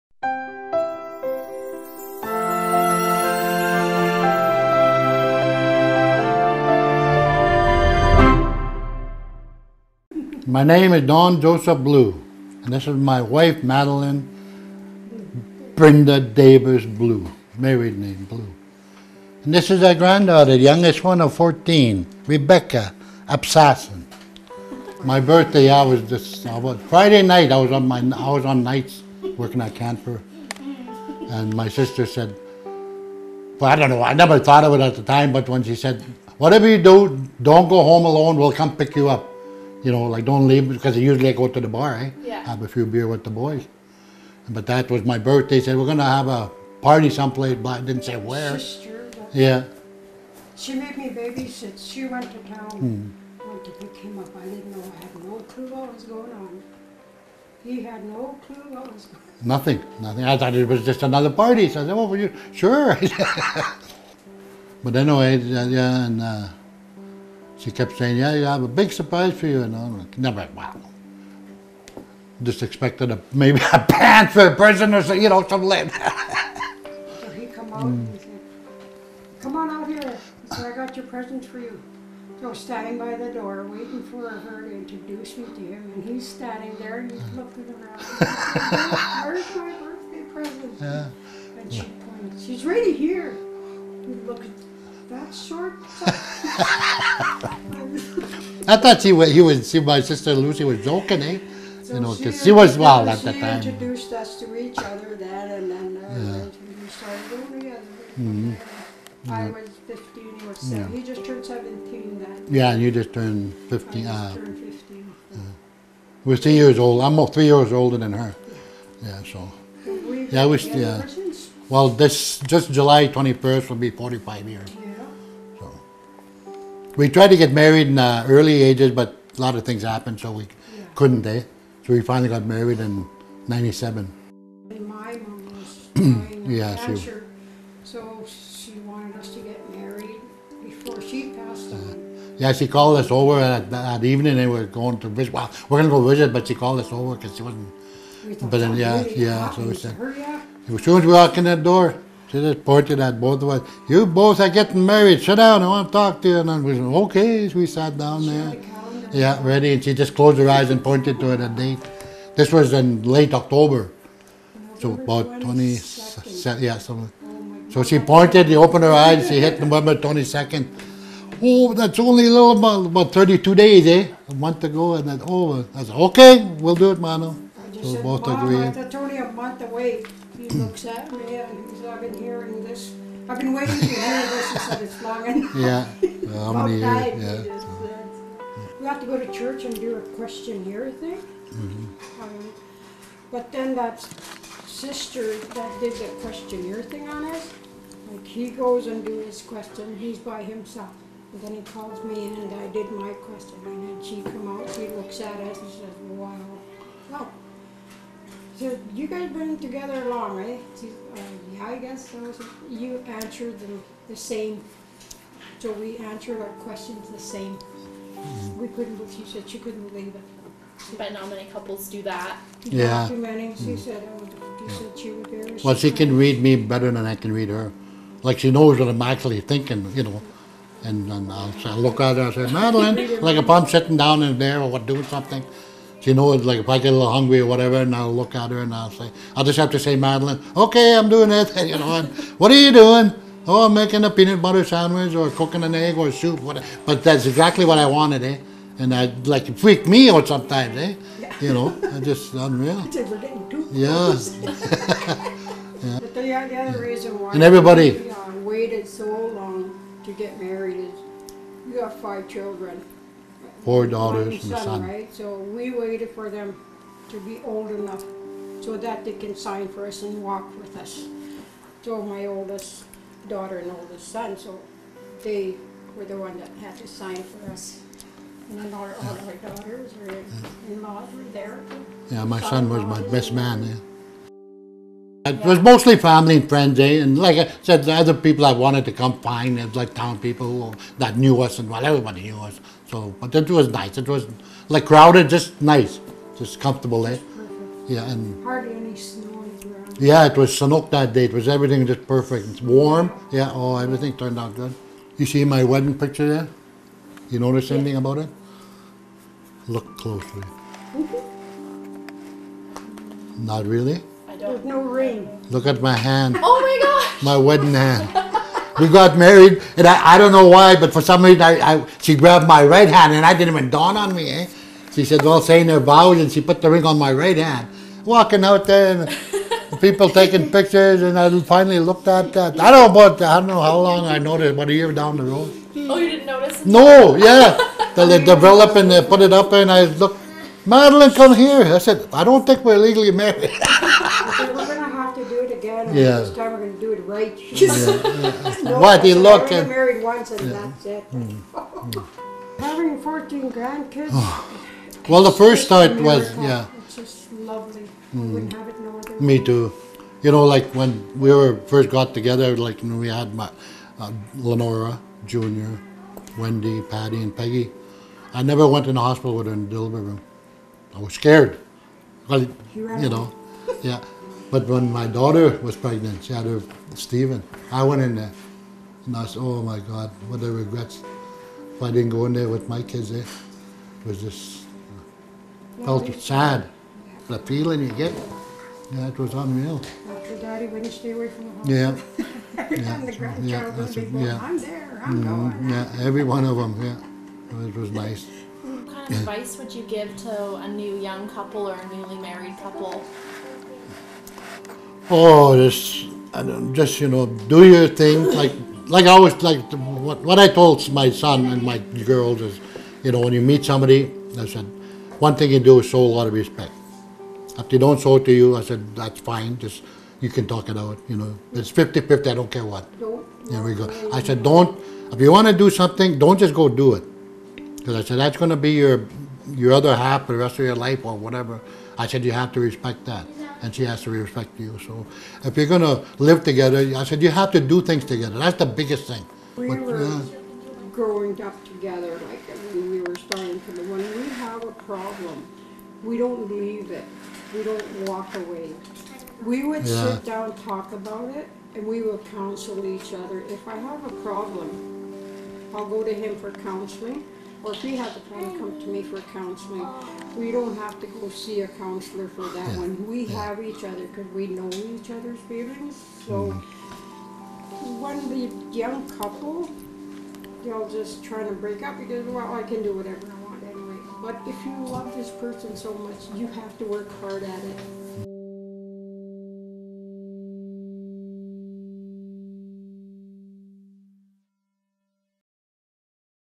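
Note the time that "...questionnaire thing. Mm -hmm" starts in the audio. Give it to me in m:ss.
3:10.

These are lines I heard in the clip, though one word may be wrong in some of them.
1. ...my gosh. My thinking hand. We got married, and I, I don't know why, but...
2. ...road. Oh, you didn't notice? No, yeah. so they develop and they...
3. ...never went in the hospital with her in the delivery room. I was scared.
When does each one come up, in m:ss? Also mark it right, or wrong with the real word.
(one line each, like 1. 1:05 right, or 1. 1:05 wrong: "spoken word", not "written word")
1. 5:16 wrong: "wedding", not "thinking"
2. 5:35 right
3. 6:08 right.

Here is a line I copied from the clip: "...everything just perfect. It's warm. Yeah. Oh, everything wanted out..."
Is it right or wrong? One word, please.
wrong.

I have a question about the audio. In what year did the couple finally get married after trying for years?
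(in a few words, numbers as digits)
1997.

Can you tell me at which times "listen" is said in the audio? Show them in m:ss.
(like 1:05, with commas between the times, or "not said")
not said.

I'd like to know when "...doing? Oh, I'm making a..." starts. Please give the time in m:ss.
4:02.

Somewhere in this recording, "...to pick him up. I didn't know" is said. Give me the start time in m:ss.
0:53.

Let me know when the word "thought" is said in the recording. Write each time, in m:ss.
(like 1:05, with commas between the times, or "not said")
0:34, 1:00, 1:38, 5:55.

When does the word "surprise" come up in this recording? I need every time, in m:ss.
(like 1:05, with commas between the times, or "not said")
1:08.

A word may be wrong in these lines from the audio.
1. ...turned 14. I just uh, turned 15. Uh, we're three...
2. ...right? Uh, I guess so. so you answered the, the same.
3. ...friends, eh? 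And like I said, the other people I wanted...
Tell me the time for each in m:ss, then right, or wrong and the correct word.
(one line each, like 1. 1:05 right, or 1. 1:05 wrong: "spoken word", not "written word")
1. 1:53 wrong: "15", not "14"
2. 3:30 right
3. 4:46 right.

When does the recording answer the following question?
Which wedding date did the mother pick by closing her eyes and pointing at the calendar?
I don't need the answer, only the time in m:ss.
2:49.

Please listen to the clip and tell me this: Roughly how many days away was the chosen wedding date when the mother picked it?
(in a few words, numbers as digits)
32.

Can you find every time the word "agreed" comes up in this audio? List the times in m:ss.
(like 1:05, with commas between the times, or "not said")
2:58.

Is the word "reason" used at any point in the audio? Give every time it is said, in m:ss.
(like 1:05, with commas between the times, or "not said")
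4:16, 5:21.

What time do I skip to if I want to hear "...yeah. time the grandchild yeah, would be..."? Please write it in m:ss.
6:32.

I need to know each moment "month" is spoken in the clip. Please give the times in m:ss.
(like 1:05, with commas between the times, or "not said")
2:54, 2:59.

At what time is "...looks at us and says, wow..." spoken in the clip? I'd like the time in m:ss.
3:24.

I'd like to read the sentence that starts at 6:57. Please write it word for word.
If they don't show it to you, I said, that's fine.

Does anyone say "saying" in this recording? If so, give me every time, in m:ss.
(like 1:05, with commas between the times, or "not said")
1:07, 5:25.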